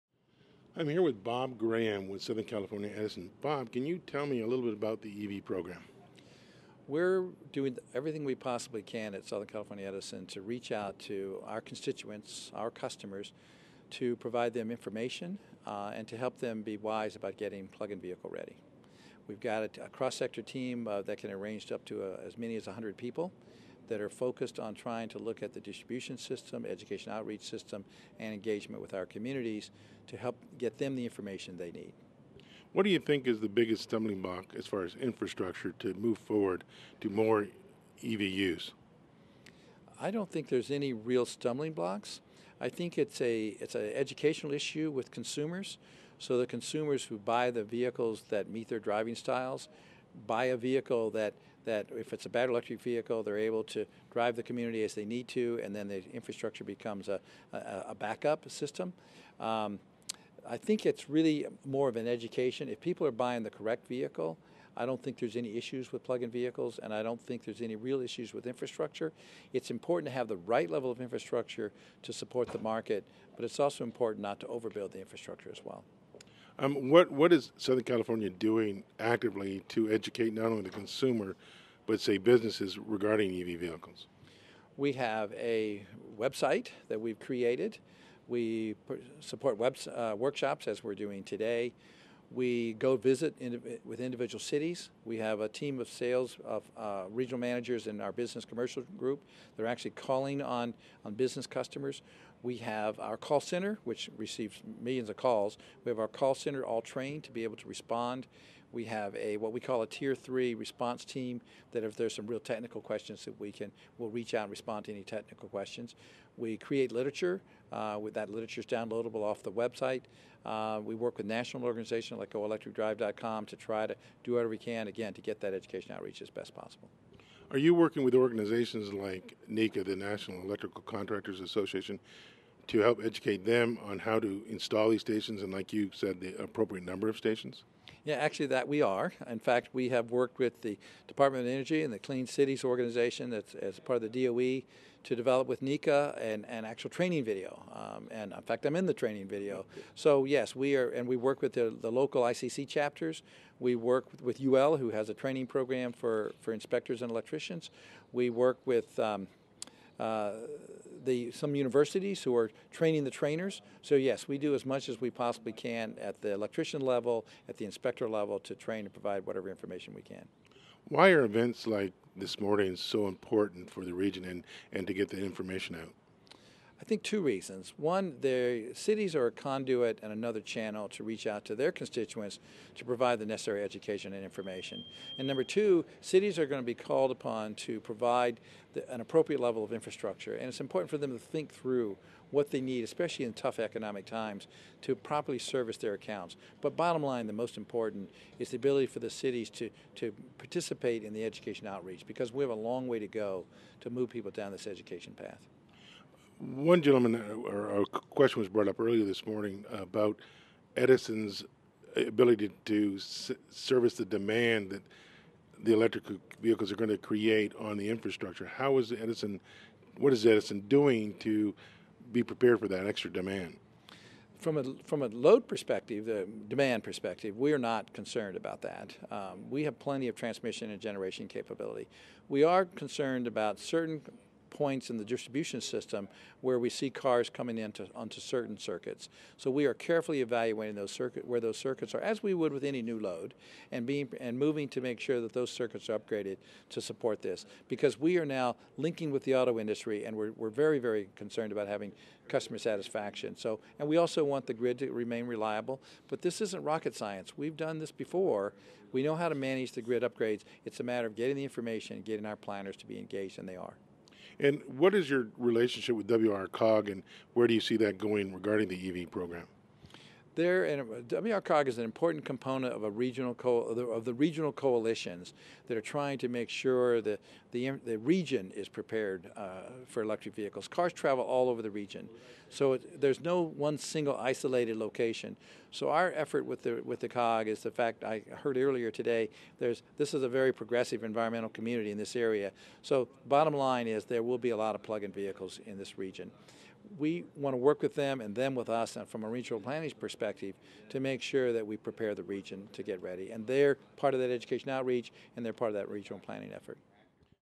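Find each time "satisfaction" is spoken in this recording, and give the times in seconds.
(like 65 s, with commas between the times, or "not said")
252 s.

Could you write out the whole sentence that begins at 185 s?
And number two, cities are going to be called upon to provide the, an appropriate level of infrastructure.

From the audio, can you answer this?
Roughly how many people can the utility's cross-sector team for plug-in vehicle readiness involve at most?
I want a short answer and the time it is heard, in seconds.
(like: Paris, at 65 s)
100, at 22 s.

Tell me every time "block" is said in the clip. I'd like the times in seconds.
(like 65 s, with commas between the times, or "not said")
34 s, 41 s.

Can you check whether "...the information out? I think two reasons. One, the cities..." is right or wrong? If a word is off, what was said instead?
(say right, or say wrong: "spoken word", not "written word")
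right.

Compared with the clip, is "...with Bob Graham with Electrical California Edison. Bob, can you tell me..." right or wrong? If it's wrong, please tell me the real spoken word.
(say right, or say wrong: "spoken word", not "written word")
wrong: "Southern", not "Electrical".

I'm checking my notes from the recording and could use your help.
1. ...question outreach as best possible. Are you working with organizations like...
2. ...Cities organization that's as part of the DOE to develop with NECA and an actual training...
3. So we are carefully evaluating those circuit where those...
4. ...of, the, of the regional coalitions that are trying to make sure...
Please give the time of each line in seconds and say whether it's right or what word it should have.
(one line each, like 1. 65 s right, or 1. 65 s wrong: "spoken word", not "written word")
1. 125 s wrong: "education", not "question"
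2. 142 s right
3. 239 s right
4. 273 s right.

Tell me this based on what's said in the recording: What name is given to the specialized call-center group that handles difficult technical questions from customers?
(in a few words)
tier three response team.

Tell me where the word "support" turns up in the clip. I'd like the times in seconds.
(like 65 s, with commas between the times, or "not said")
72 s, 89 s, 246 s.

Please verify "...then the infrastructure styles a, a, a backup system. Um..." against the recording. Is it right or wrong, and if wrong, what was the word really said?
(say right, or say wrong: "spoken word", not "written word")
wrong: "becomes", not "styles".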